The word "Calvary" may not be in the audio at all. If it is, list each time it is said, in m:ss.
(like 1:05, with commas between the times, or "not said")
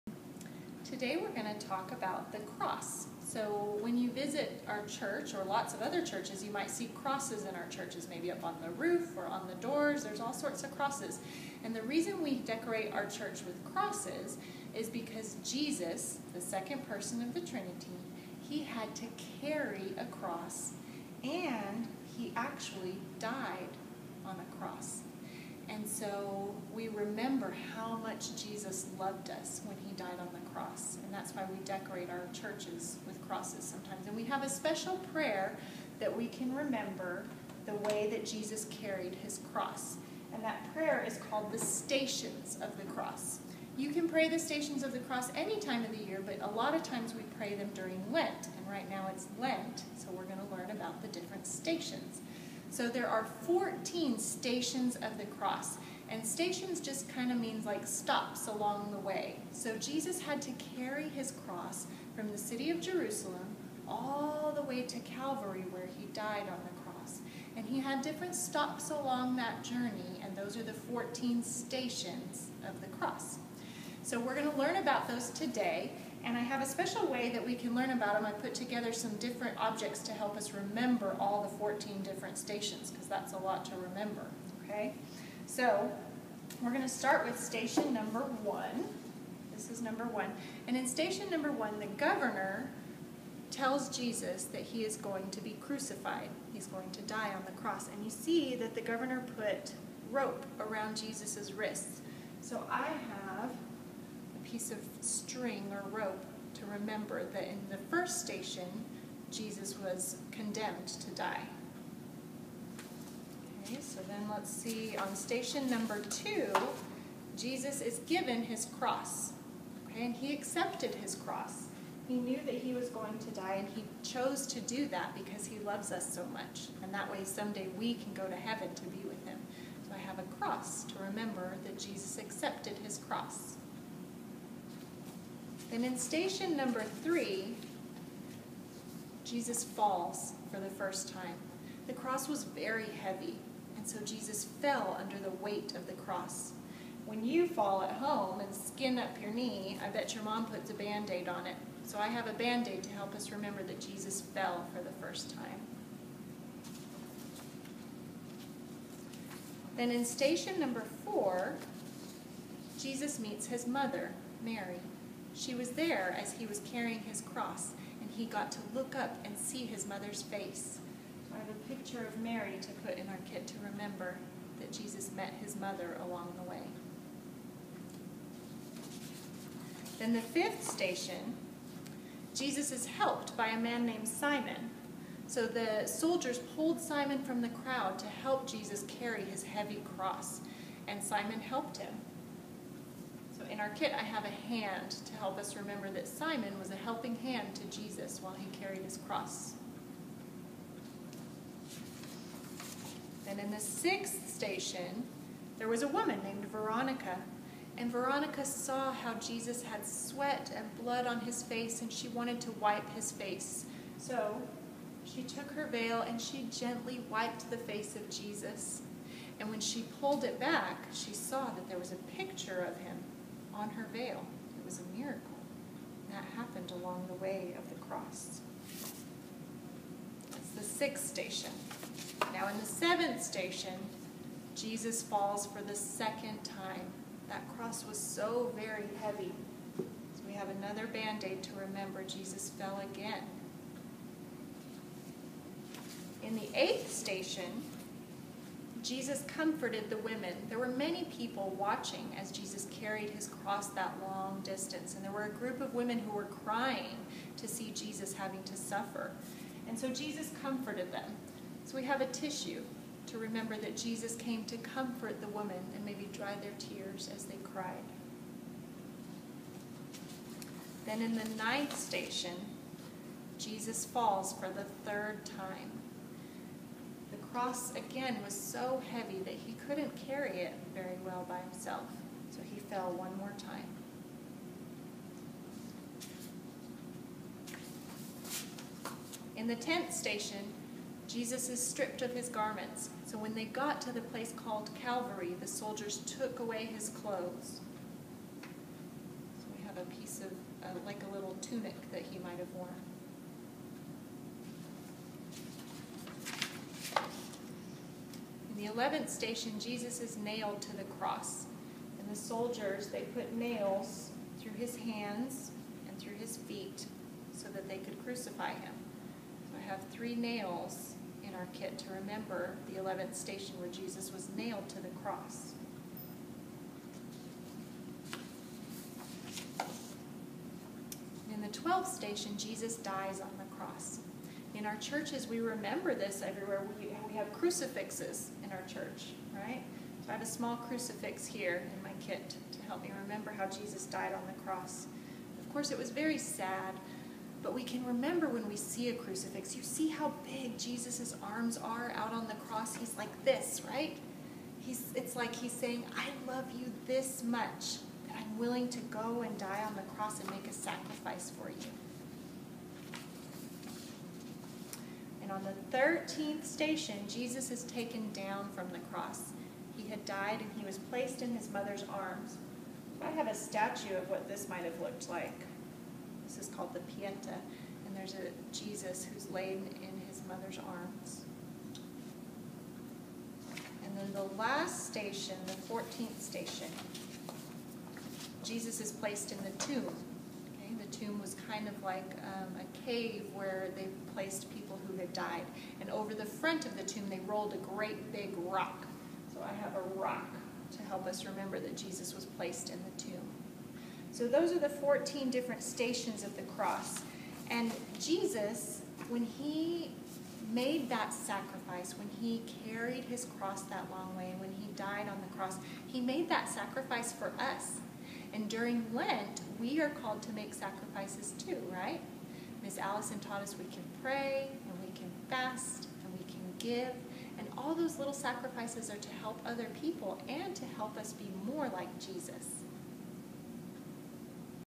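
1:05, 4:54.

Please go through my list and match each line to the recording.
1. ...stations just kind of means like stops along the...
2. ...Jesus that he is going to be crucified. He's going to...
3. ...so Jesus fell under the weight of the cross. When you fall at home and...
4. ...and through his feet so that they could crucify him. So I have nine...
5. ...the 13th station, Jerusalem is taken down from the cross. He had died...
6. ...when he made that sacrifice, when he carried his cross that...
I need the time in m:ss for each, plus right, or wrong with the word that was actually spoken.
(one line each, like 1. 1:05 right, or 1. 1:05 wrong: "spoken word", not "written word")
1. 0:56 right
2. 1:33 right
3. 2:23 right
4. 5:15 wrong: "three", not "nine"
5. 6:05 wrong: "Jesus", not "Jerusalem"
6. 6:49 right.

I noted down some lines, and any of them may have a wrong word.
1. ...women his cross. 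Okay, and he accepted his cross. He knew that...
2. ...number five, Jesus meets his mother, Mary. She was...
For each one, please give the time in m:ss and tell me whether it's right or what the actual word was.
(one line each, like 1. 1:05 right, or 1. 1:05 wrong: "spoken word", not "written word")
1. 1:57 wrong: "given", not "women"
2. 2:40 wrong: "four", not "five".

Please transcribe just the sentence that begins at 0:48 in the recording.
And right now it's Lent, so we're going to learn about the different stations.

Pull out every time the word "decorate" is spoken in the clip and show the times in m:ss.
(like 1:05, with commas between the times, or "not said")
0:12, 0:31.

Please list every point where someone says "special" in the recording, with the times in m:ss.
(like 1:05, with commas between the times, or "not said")
0:34, 1:16.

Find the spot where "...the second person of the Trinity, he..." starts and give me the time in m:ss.
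0:16.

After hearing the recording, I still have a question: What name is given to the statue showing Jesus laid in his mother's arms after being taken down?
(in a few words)
Pieta.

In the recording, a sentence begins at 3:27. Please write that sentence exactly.
And Veronica saw how Jesus had sweat and blood on his face, and she wanted to wipe his face.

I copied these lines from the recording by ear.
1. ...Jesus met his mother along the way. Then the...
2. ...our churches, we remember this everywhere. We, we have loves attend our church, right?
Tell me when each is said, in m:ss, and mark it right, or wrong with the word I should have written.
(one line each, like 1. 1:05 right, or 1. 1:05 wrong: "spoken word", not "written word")
1. 2:54 right
2. 5:34 wrong: "crucifixes", not "loves".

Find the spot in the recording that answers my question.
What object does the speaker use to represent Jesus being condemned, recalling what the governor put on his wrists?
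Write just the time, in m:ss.
1:44.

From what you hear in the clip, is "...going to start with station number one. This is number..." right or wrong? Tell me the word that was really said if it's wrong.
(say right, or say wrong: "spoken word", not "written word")
right.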